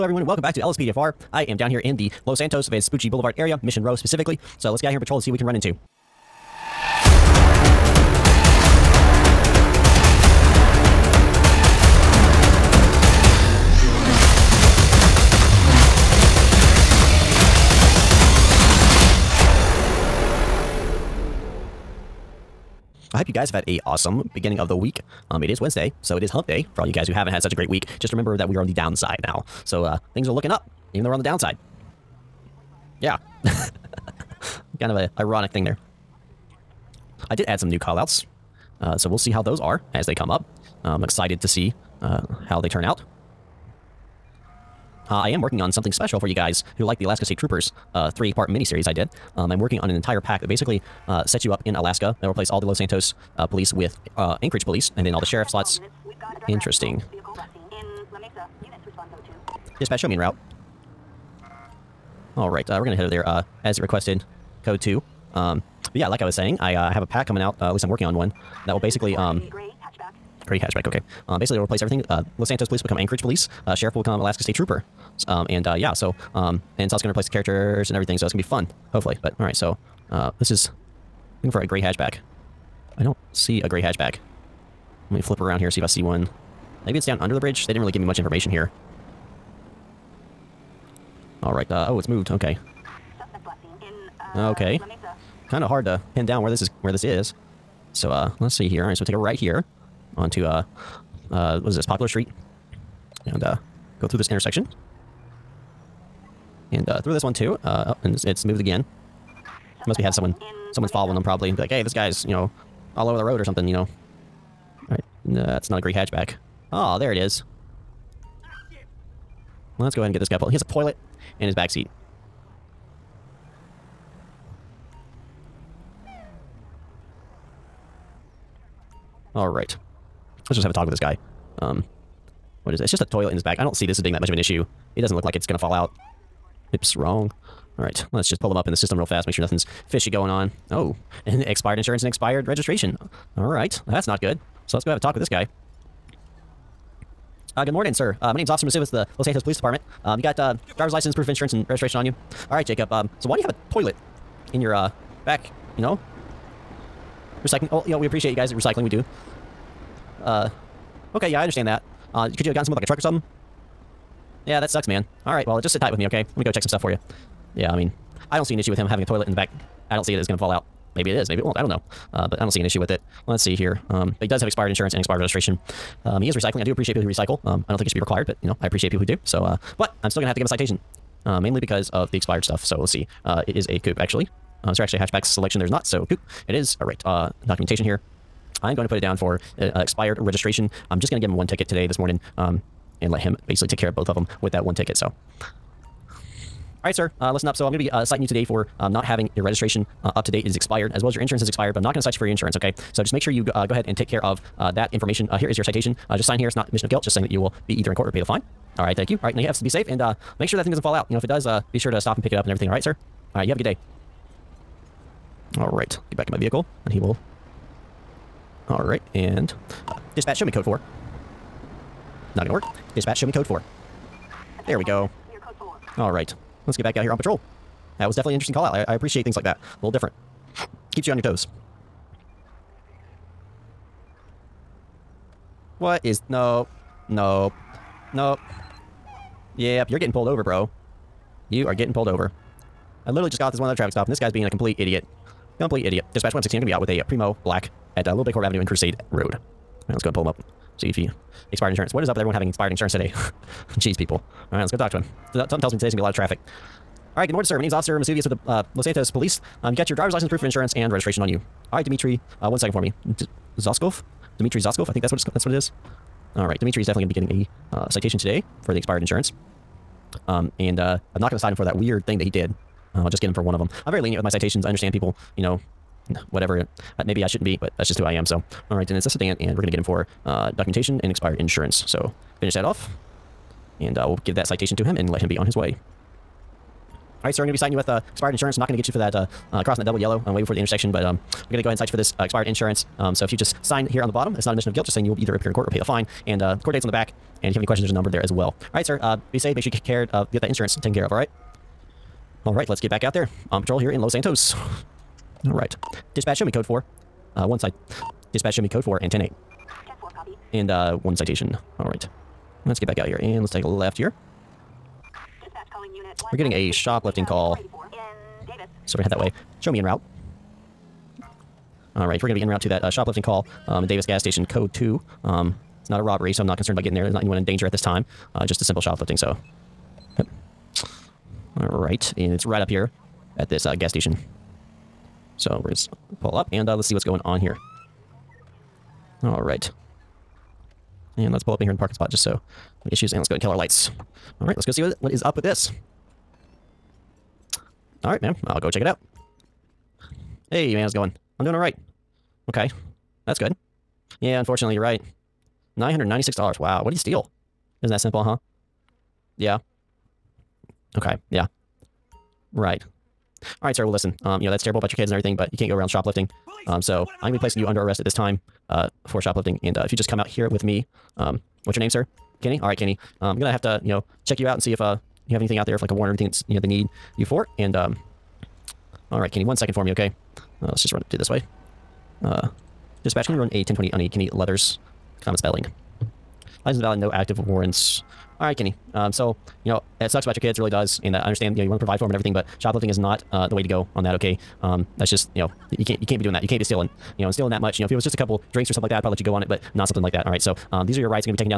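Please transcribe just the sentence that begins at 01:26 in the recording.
Maybe it's down under the bridge?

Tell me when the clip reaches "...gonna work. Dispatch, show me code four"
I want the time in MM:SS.
03:42.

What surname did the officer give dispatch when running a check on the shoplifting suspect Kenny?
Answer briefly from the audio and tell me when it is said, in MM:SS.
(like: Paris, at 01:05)
Leathers, at 06:24.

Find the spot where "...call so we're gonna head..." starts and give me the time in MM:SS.
05:17.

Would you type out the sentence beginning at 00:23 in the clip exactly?
I hope you guys have had a awesome beginning of the week.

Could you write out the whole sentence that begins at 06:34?
Okay, um, that's just you know, you can't you can't be doing that.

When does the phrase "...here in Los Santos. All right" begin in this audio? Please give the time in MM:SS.
05:03.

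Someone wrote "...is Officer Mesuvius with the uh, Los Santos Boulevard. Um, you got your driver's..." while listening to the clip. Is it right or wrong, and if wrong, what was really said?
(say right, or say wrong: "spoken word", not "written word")
wrong: "Police", not "Boulevard".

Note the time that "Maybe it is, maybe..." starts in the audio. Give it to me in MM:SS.
02:50.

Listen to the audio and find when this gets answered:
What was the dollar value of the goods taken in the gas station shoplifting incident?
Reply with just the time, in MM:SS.
05:55.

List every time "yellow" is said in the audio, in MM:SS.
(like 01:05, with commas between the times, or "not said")
04:49.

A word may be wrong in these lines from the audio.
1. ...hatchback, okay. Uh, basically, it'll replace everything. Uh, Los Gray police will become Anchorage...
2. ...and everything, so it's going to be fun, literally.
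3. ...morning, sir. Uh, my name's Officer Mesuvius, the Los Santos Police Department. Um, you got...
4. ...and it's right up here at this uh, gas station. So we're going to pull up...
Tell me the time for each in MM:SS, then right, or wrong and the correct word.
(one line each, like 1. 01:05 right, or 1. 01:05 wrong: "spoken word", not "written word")
1. 01:10 wrong: "Santos", not "Gray"
2. 01:17 wrong: "hopefully", not "literally"
3. 02:27 right
4. 05:32 right.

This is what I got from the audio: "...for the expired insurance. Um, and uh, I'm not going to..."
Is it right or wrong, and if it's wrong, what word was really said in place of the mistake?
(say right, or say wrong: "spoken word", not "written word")
right.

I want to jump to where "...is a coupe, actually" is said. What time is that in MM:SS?
03:03.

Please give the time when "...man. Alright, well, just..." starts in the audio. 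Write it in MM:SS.
02:44.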